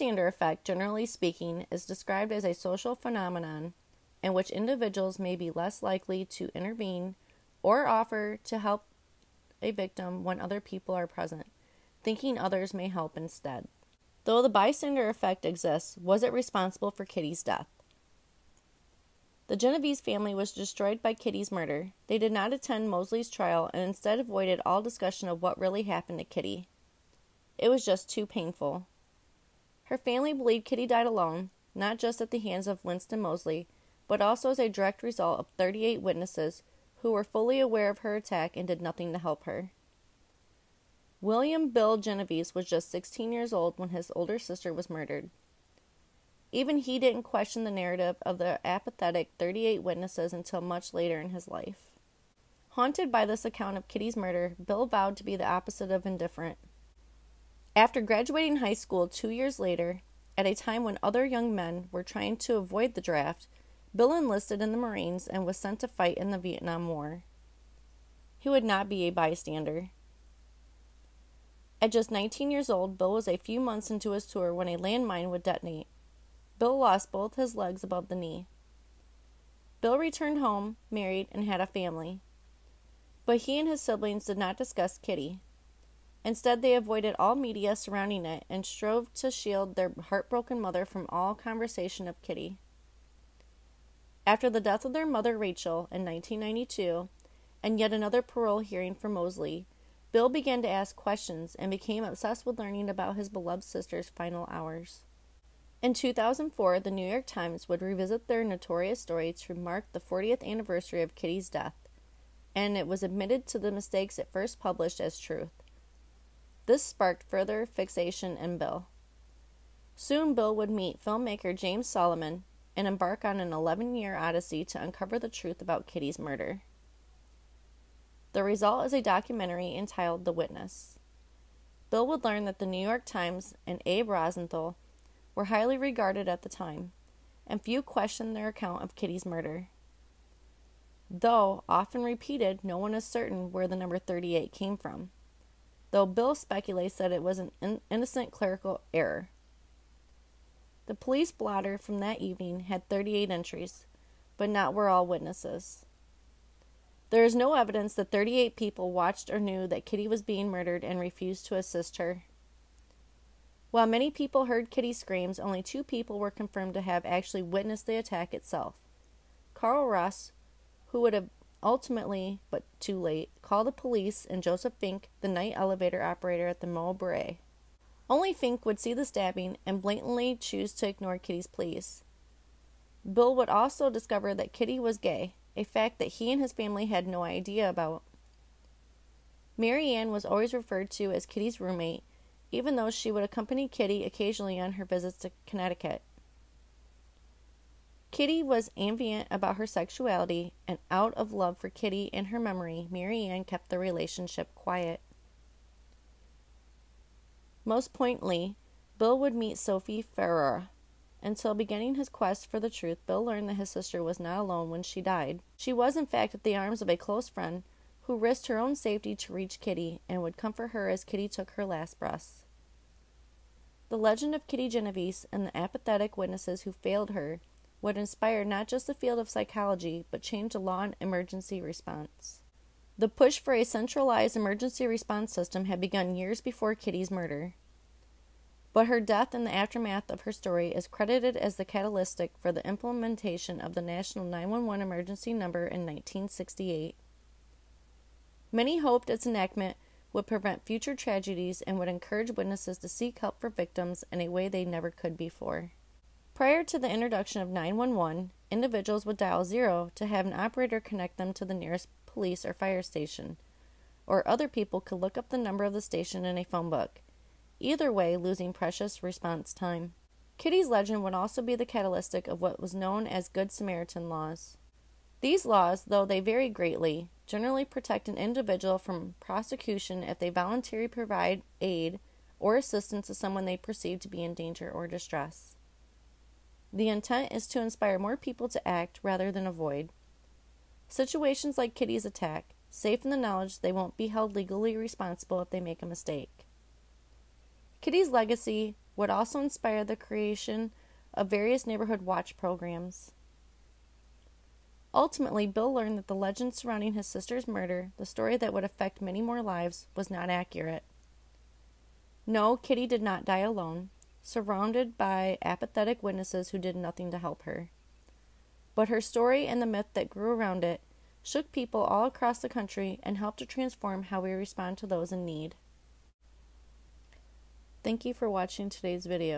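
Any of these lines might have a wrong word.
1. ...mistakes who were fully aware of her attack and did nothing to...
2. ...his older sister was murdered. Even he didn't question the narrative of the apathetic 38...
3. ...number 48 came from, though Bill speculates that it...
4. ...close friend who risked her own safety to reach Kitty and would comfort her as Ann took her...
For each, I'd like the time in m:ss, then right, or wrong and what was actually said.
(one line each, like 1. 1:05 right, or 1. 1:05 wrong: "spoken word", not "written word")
1. 0:36 wrong: "witnesses", not "mistakes"
2. 0:43 right
3. 2:23 wrong: "38", not "48"
4. 3:36 wrong: "Kitty", not "Ann".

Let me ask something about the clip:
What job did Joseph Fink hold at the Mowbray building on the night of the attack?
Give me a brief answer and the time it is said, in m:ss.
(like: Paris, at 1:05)
night elevator operator, at 2:55.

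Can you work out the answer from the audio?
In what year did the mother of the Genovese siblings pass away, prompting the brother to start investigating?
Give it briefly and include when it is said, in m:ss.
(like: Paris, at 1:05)
1992, at 1:36.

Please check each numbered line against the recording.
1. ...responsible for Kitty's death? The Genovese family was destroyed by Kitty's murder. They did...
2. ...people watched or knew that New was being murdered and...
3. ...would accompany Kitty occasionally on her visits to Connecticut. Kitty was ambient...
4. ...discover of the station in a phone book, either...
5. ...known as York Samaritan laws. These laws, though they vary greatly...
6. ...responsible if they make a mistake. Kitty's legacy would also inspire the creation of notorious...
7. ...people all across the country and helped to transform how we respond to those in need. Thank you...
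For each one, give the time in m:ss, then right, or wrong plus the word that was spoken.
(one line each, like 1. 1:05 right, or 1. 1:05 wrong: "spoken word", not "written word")
1. 0:16 right
2. 2:38 wrong: "Kitty", not "New"
3. 3:13 right
4. 4:25 wrong: "number", not "discover"
5. 4:32 wrong: "Good", not "York"
6. 4:54 wrong: "various", not "notorious"
7. 5:21 right.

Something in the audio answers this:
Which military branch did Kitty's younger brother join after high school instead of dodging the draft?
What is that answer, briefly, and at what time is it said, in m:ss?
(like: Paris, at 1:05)
Marines, at 1:04.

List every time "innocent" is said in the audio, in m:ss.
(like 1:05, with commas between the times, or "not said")
2:27.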